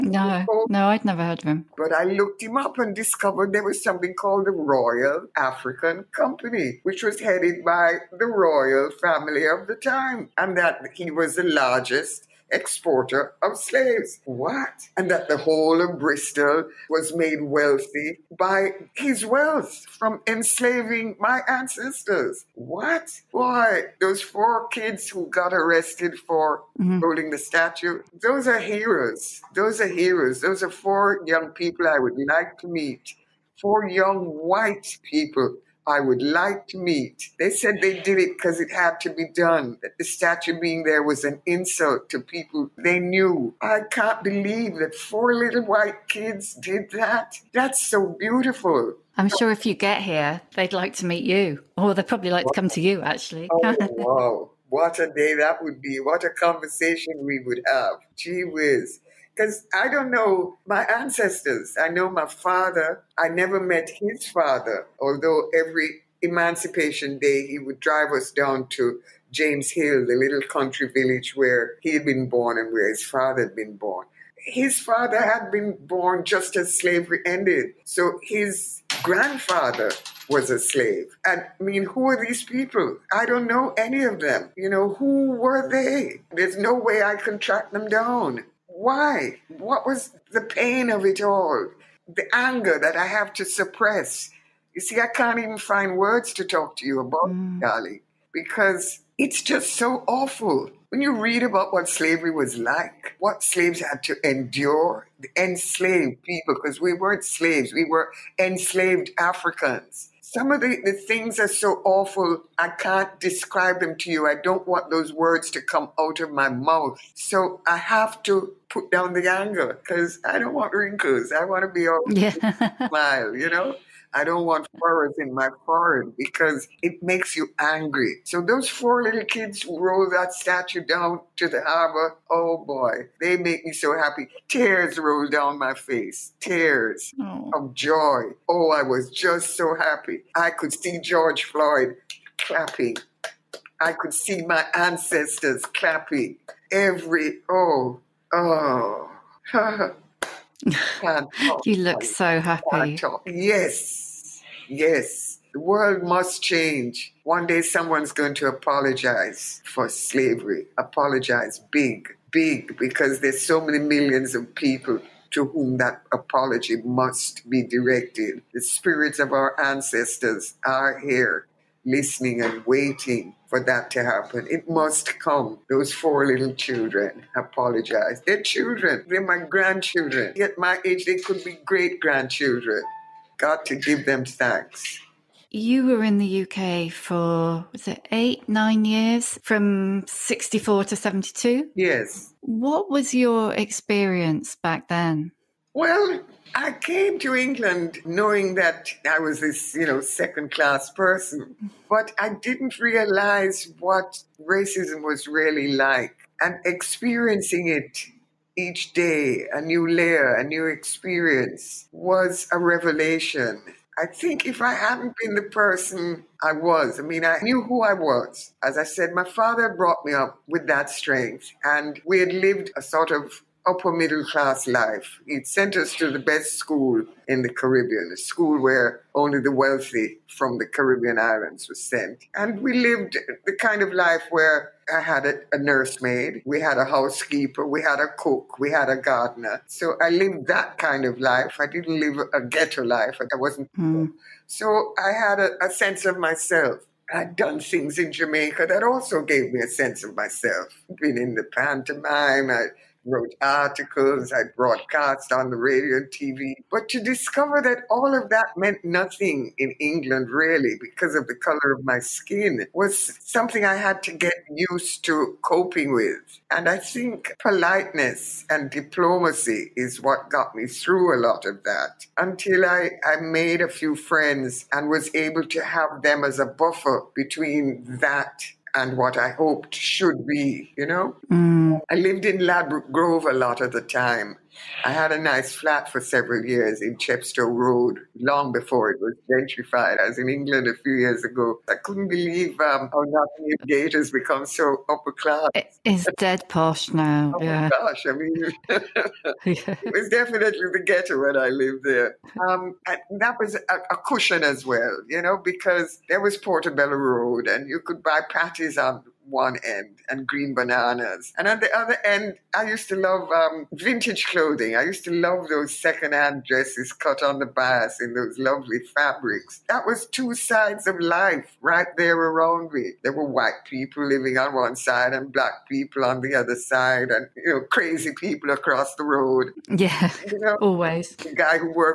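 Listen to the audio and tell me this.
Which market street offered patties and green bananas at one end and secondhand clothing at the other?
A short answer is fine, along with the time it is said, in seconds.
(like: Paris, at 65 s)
Portobello Road, at 306 s.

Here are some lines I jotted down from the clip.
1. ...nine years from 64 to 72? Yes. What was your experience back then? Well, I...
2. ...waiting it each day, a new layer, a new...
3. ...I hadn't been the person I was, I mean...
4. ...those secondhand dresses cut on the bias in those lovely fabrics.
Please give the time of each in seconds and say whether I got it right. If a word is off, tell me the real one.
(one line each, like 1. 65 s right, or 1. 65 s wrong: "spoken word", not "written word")
1. 188 s right
2. 206 s wrong: "experiencing", not "waiting"
3. 214 s right
4. 315 s right.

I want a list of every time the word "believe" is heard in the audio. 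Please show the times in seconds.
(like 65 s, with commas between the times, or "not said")
44 s, 292 s.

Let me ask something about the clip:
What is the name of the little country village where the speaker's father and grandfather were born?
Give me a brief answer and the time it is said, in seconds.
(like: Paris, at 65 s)
James Hill, at 69 s.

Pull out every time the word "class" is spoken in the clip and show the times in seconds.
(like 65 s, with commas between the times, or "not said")
200 s, 224 s, 295 s.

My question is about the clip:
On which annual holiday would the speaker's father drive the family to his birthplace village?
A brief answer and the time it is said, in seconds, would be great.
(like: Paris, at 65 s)
Emancipation Day, at 66 s.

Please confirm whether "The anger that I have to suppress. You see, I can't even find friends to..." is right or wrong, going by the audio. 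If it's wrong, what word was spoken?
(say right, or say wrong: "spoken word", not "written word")
wrong: "words", not "friends".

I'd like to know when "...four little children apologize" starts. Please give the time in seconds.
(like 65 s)
175 s.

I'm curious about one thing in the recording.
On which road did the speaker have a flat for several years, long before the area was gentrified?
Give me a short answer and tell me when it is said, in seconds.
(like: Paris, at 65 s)
Chepstow Road, at 286 s.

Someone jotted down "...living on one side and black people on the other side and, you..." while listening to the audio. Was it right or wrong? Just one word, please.
right.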